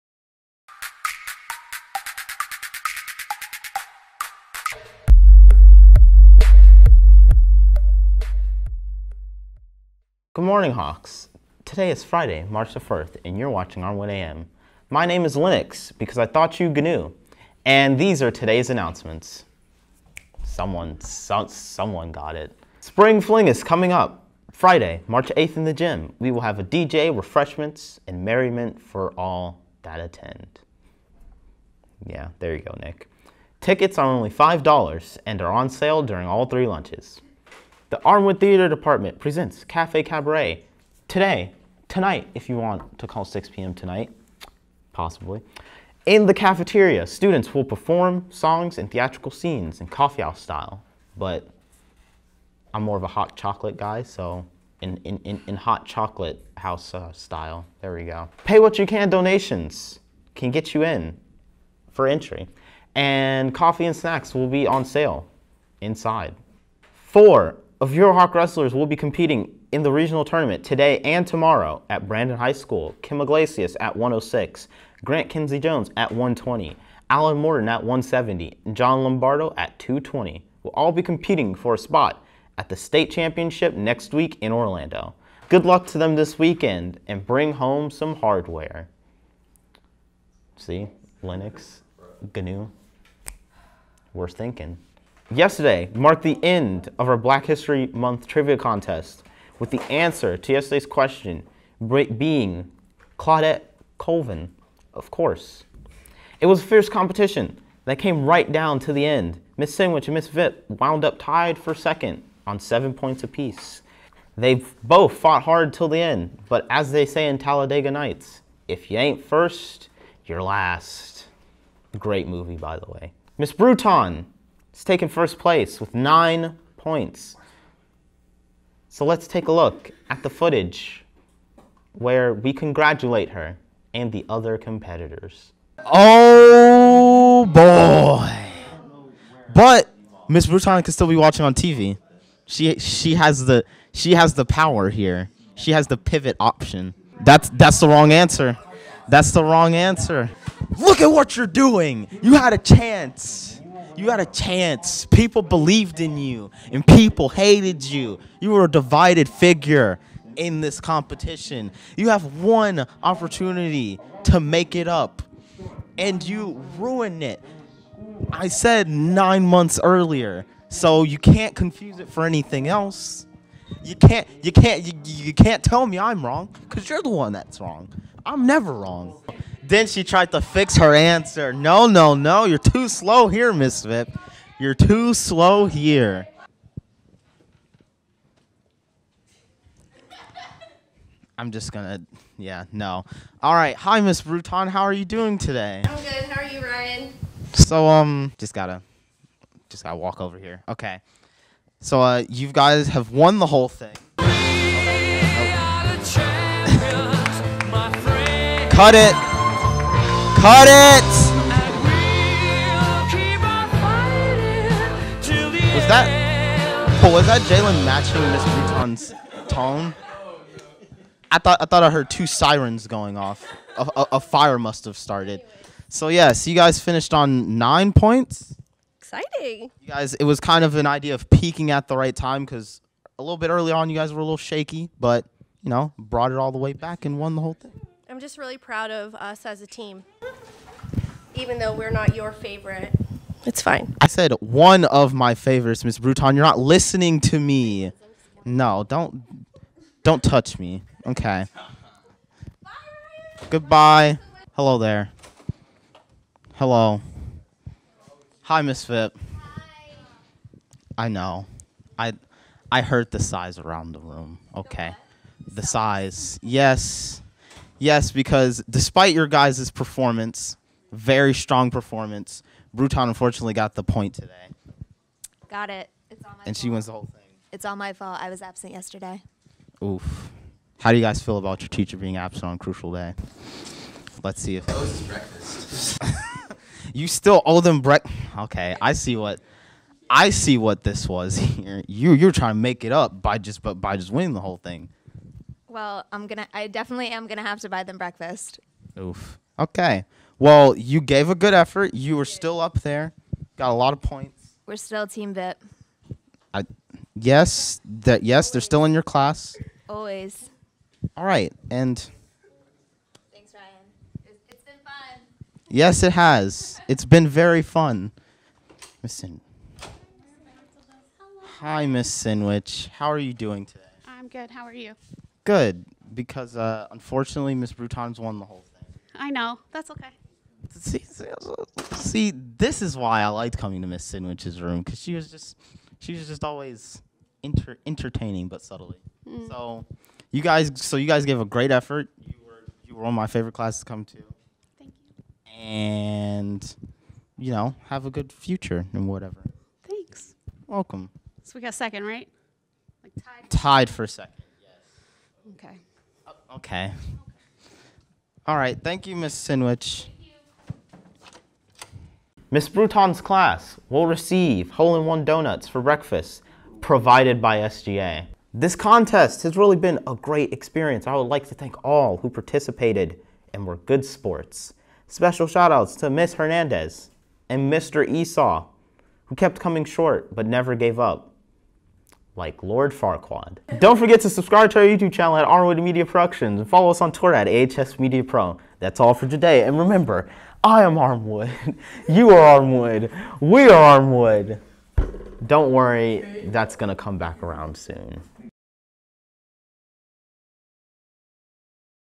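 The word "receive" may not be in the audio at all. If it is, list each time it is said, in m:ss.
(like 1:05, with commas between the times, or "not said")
6:04.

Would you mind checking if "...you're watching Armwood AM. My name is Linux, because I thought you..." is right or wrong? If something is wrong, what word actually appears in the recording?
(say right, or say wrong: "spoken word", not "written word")
right.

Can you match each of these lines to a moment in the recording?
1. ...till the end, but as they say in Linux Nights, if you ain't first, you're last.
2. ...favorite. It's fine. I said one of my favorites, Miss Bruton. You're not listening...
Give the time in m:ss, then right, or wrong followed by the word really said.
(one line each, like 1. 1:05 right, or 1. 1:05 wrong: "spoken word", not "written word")
1. 1:55 wrong: "Talladega", not "Linux"
2. 4:02 right.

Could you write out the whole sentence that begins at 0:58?
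Pay what you can donations can get you in for entry, and coffee and snacks will be on sale inside.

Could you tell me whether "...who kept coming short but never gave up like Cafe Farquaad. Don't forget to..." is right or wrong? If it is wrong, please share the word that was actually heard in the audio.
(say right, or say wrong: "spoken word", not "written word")
wrong: "Lord", not "Cafe".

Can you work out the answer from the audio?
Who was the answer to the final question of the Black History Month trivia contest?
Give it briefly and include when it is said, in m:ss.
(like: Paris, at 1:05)
Claudette Colvin, at 1:43.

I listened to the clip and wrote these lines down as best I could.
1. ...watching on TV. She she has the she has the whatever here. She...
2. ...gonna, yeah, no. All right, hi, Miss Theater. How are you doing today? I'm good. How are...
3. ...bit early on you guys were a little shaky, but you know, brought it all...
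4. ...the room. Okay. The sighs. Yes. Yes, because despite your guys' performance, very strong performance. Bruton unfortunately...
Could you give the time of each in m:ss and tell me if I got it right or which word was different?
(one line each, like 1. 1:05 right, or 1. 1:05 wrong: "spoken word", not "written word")
1. 2:21 wrong: "power", not "whatever"
2. 3:11 wrong: "Bruton", not "Theater"
3. 3:53 right
4. 4:23 right.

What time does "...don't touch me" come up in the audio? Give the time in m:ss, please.
4:10.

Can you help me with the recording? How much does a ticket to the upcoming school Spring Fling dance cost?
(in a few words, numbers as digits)
$5.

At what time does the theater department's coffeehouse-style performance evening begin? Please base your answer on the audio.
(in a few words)
6 p.m.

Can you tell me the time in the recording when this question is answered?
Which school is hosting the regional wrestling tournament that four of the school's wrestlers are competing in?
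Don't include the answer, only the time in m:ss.
1:12.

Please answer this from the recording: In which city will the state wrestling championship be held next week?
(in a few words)
Orlando.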